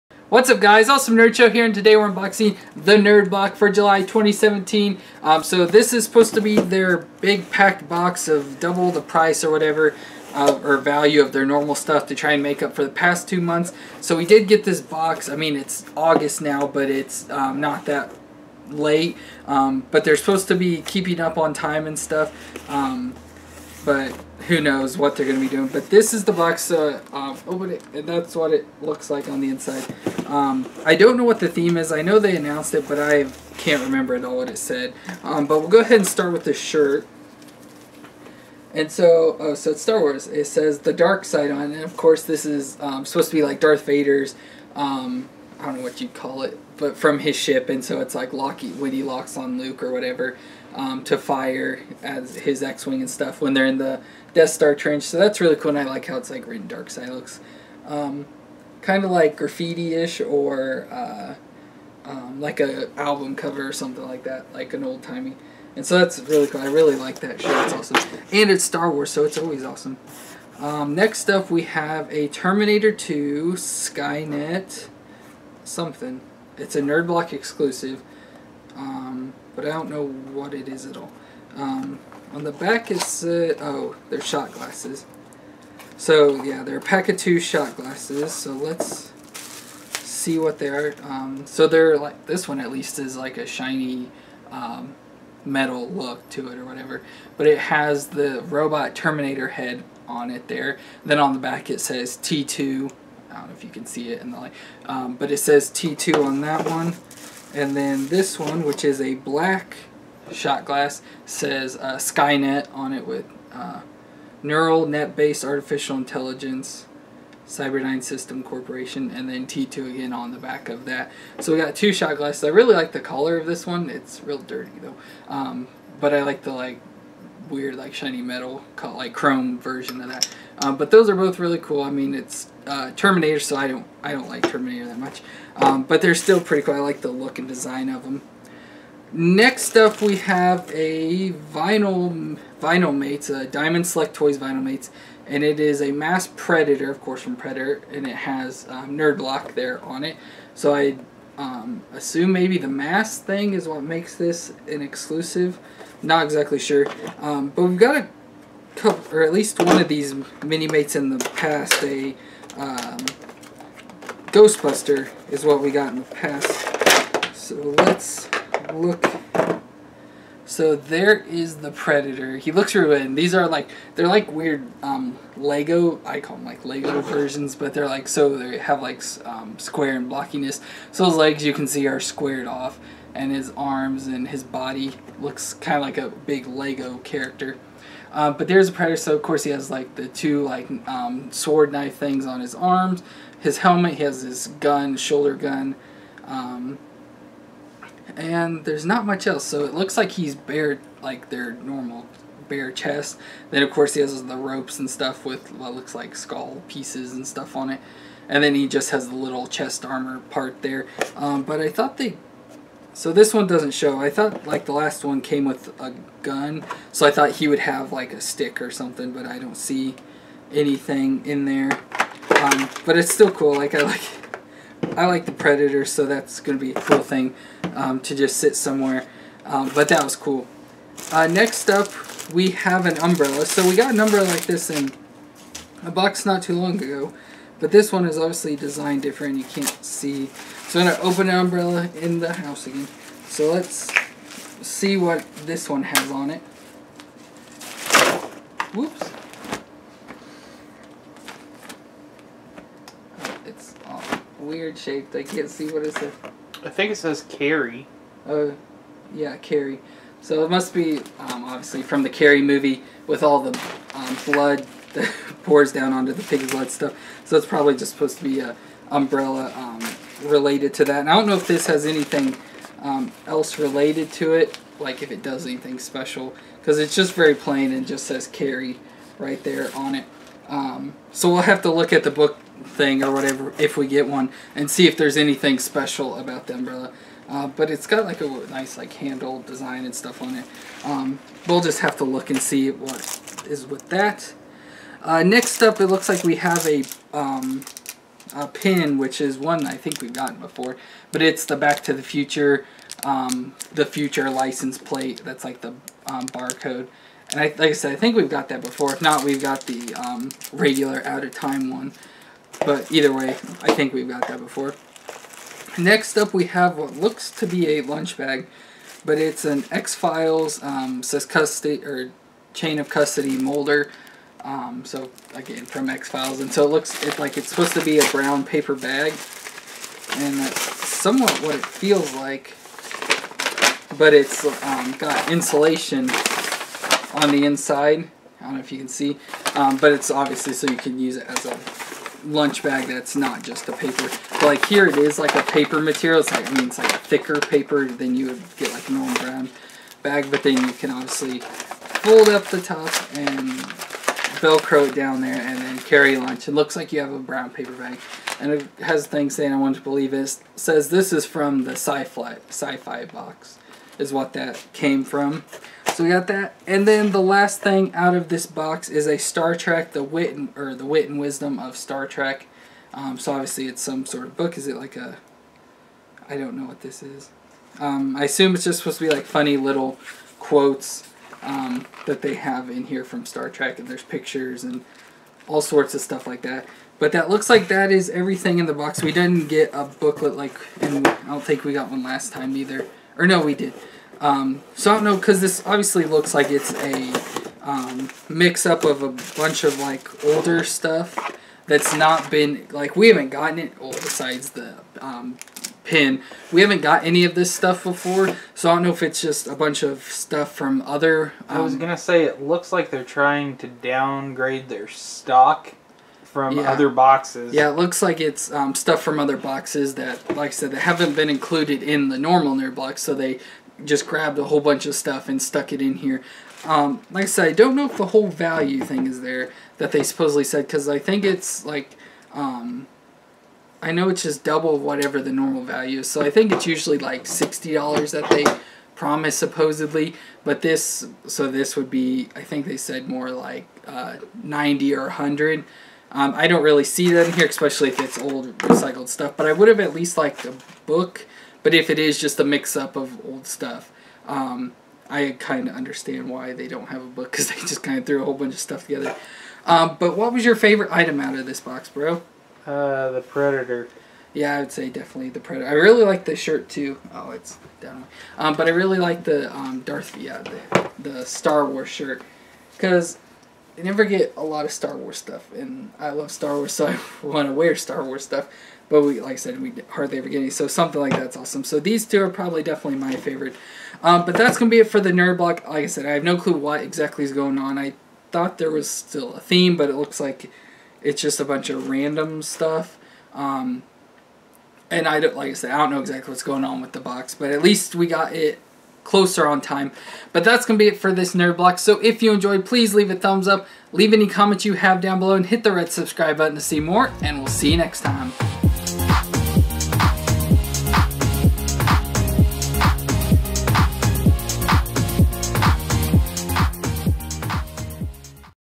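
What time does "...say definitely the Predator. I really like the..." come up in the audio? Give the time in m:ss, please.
7:44.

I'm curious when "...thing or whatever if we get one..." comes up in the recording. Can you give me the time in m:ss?
4:42.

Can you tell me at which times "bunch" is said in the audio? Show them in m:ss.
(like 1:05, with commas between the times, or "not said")
6:39, 6:49, 7:04, 7:38, 8:11.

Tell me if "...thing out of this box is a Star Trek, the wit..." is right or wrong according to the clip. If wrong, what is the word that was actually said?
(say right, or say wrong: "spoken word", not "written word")
right.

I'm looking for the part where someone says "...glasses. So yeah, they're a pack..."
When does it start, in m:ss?
1:24.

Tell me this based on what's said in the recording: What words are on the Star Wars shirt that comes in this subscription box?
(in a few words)
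The dark side.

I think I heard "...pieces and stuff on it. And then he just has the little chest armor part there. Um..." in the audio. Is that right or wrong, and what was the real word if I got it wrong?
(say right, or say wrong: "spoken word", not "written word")
right.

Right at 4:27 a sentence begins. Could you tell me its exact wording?
So it's probably just supposed to be a umbrella um, related to that.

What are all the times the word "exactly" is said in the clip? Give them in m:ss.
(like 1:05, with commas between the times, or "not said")
2:36, 8:06, 8:16.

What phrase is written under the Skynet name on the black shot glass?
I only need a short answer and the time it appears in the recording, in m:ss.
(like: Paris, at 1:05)
Neural Net-Based Artificial Intelligence, at 1:54.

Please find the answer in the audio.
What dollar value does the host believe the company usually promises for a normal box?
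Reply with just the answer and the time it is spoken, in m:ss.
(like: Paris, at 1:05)
$60, at 7:17.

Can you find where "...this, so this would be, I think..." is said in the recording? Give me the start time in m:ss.
7:20.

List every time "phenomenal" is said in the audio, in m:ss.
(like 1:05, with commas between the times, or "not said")
not said.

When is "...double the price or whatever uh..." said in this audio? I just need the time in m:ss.
0:08.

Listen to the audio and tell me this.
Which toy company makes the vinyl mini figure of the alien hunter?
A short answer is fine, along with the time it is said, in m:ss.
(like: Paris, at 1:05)
Diamond Select Toys, at 2:23.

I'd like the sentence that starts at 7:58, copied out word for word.
But we, like I said, we hardly ever get any, so something like that's awesome.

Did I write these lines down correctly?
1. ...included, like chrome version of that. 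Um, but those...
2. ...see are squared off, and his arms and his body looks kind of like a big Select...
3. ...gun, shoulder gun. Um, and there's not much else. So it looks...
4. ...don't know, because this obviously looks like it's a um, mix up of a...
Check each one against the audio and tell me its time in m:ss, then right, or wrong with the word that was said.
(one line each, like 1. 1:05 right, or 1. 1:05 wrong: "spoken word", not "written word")
1. 2:08 wrong: "called", not "included"
2. 3:01 wrong: "Lego", not "Select"
3. 3:14 right
4. 6:34 right.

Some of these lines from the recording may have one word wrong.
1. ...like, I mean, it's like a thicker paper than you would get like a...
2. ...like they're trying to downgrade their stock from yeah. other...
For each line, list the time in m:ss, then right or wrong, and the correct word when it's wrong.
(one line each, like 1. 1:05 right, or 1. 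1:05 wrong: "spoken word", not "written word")
1. 5:46 right
2. 6:52 right.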